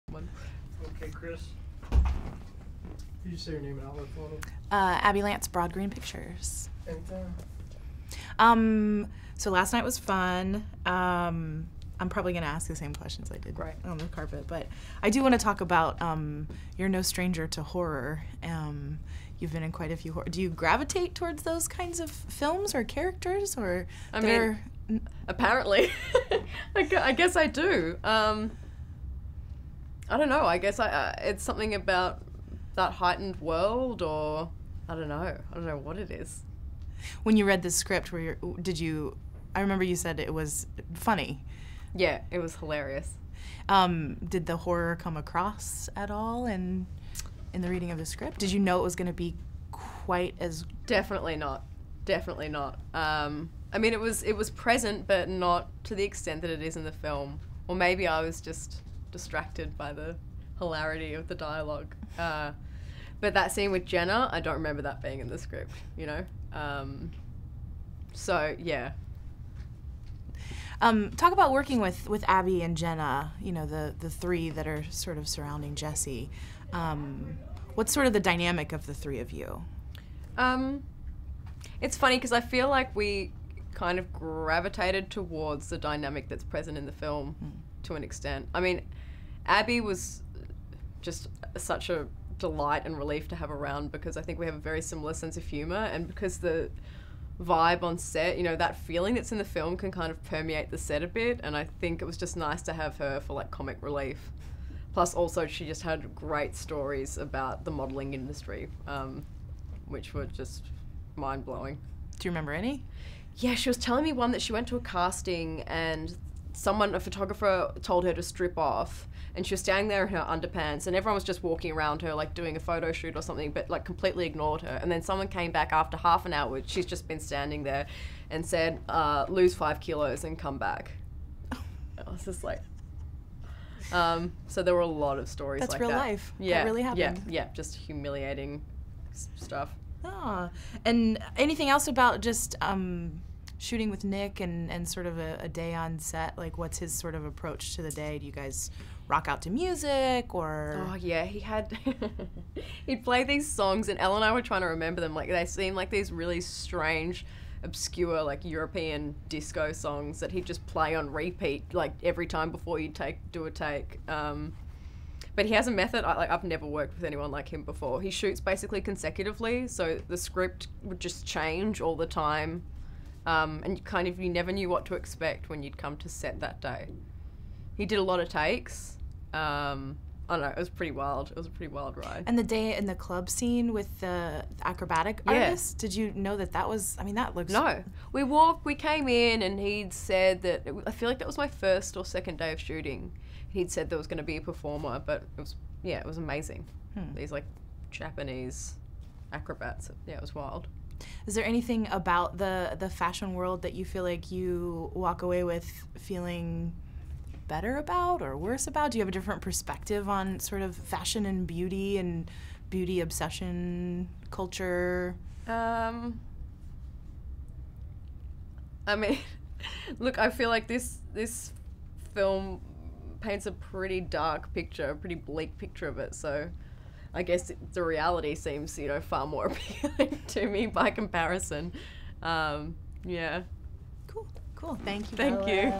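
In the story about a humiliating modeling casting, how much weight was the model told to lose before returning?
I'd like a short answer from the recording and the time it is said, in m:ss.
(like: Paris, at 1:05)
5 kilos, at 2:09.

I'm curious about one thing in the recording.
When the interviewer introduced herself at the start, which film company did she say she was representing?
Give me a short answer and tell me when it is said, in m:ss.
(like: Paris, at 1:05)
Broad Green Pictures, at 0:05.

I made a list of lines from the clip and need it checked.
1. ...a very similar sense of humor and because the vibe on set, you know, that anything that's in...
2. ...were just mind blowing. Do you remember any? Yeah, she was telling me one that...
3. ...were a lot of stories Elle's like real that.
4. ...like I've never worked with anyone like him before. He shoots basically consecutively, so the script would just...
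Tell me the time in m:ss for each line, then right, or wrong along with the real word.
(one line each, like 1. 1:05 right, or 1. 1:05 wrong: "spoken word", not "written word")
1. 1:34 wrong: "feeling", not "anything"
2. 1:50 right
3. 2:14 wrong: "That", not "Elle"
4. 2:46 right.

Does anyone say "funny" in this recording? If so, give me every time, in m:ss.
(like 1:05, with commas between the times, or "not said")
0:40, 1:21.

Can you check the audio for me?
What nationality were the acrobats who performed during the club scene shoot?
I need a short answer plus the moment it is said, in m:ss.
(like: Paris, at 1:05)
Japanese, at 3:17.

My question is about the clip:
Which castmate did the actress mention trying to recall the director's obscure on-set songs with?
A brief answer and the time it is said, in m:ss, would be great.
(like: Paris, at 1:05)
Elle, at 2:33.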